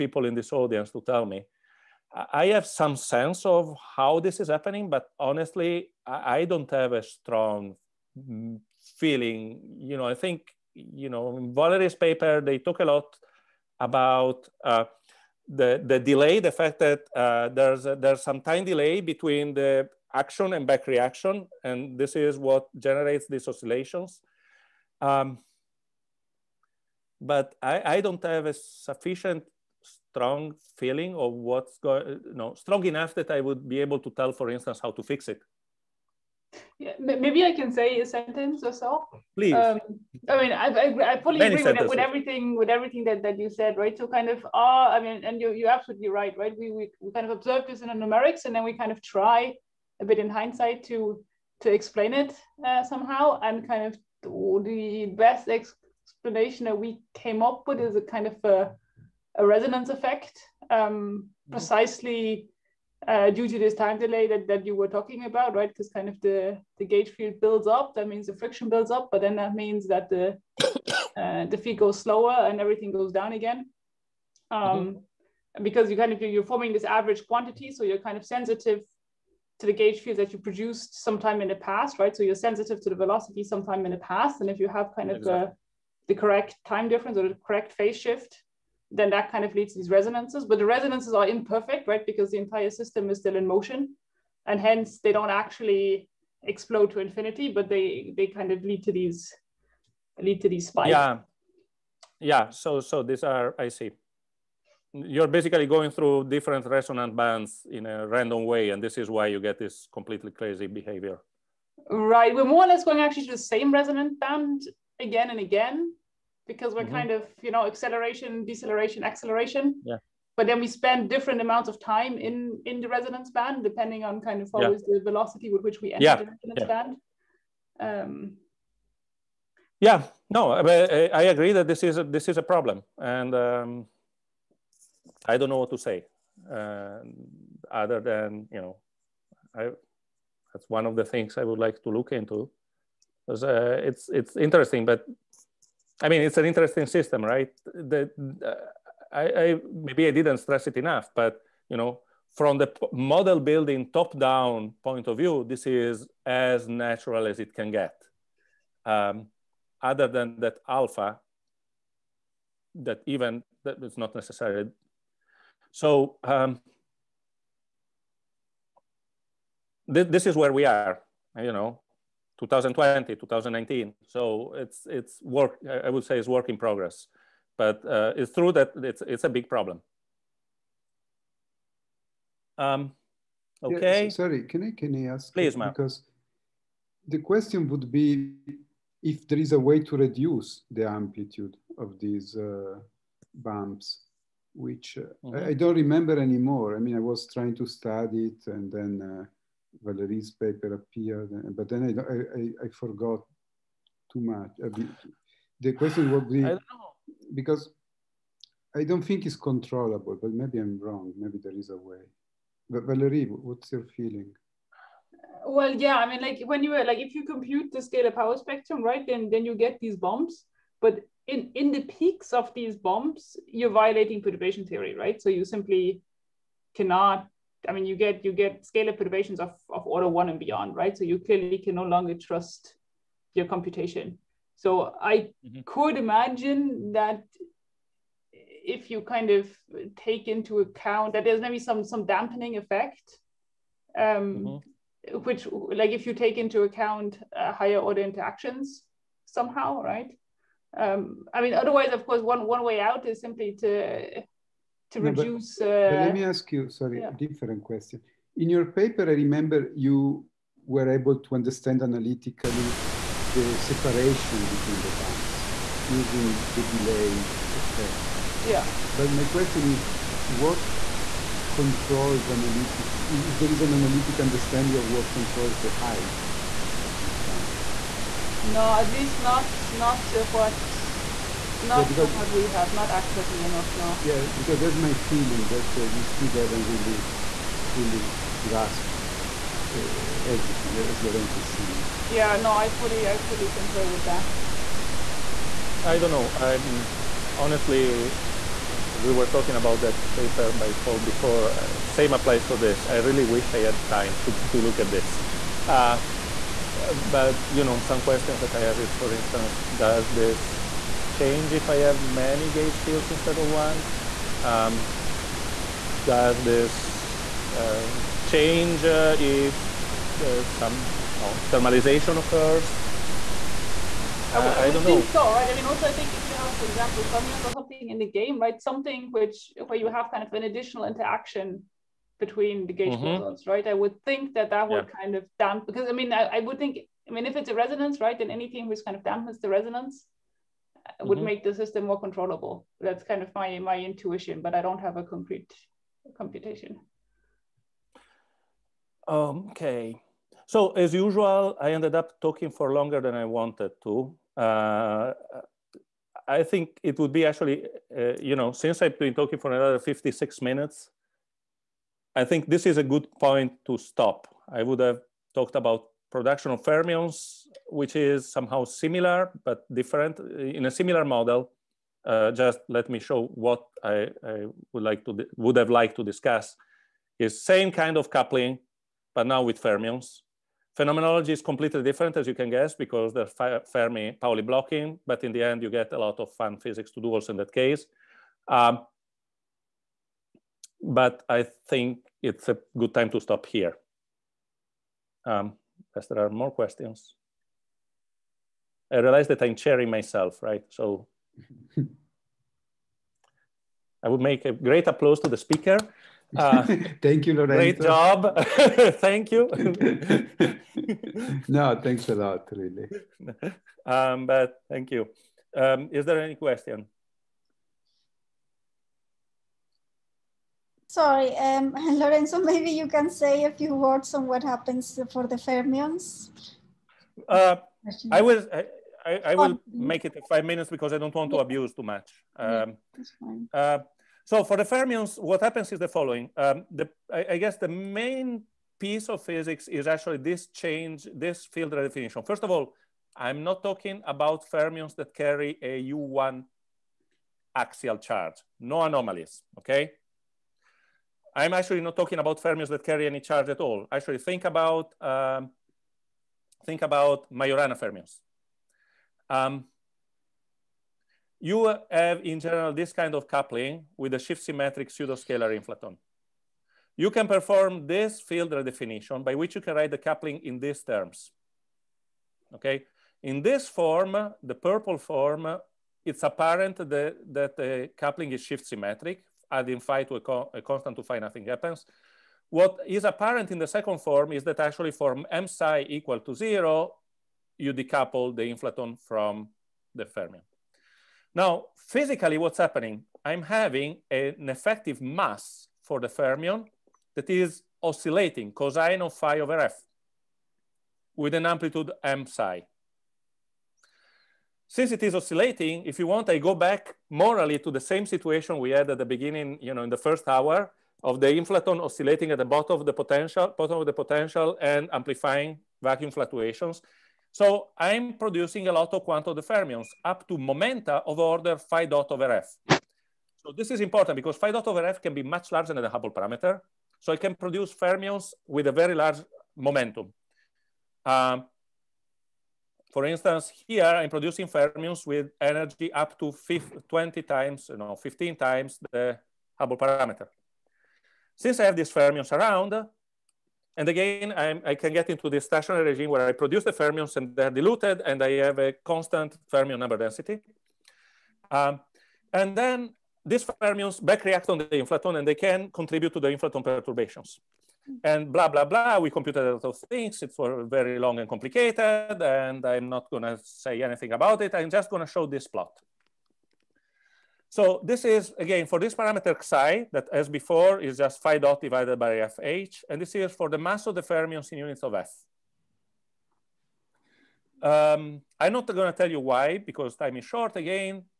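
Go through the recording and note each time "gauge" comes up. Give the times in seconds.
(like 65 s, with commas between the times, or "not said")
66 s, 79 s, 312 s, 332 s.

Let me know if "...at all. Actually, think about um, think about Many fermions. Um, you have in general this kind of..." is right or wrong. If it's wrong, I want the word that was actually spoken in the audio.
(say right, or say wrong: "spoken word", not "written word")
wrong: "Majorana", not "Many".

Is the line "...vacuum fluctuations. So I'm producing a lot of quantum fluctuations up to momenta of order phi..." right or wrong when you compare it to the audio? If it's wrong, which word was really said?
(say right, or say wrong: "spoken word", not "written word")
wrong: "fermions", not "fluctuations".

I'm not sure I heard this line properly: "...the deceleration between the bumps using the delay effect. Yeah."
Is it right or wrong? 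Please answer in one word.
wrong.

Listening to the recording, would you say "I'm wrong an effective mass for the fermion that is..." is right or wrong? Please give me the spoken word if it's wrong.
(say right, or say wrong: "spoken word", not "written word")
wrong: "having", not "wrong".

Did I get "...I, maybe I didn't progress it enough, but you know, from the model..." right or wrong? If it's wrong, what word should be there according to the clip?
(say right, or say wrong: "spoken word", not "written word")
wrong: "stress", not "progress".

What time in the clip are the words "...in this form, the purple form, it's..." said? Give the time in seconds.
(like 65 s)
473 s.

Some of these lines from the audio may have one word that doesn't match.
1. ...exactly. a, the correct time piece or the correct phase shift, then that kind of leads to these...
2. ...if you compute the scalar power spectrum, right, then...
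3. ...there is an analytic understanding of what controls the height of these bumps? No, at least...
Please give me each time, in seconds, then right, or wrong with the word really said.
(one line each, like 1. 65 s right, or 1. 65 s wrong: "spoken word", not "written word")
1. 85 s wrong: "difference", not "piece"
2. 216 s right
3. 273 s right.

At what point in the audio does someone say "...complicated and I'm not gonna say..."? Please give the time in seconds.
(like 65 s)
561 s.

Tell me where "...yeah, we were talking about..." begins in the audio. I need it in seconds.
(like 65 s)
298 s.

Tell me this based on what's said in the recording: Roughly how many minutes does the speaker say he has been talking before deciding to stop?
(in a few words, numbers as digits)
56.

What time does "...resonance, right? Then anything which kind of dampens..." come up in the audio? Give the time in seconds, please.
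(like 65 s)
337 s.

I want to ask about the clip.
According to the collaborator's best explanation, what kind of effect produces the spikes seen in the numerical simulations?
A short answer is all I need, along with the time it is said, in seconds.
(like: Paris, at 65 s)
A resonance effect, at 59 s.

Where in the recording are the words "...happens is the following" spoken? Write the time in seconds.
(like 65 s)
435 s.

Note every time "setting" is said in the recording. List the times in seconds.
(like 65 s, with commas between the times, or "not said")
not said.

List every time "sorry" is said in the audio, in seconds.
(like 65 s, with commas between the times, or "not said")
184 s, 256 s, 420 s.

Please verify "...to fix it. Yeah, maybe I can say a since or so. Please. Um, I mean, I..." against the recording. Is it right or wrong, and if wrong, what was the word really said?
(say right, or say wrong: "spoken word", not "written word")
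wrong: "sentence", not "since".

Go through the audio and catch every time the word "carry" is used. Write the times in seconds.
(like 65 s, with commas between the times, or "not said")
445 s, 452 s.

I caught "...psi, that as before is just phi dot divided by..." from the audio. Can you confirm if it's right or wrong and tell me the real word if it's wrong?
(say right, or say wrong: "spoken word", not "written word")
right.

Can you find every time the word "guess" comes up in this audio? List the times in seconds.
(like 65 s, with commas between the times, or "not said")
382 s, 437 s.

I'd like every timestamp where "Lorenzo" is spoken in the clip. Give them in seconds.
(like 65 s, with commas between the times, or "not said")
291 s, 407 s, 421 s.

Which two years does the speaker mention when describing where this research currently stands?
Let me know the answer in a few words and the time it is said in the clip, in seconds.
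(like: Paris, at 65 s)
2020, 2019, at 172 s.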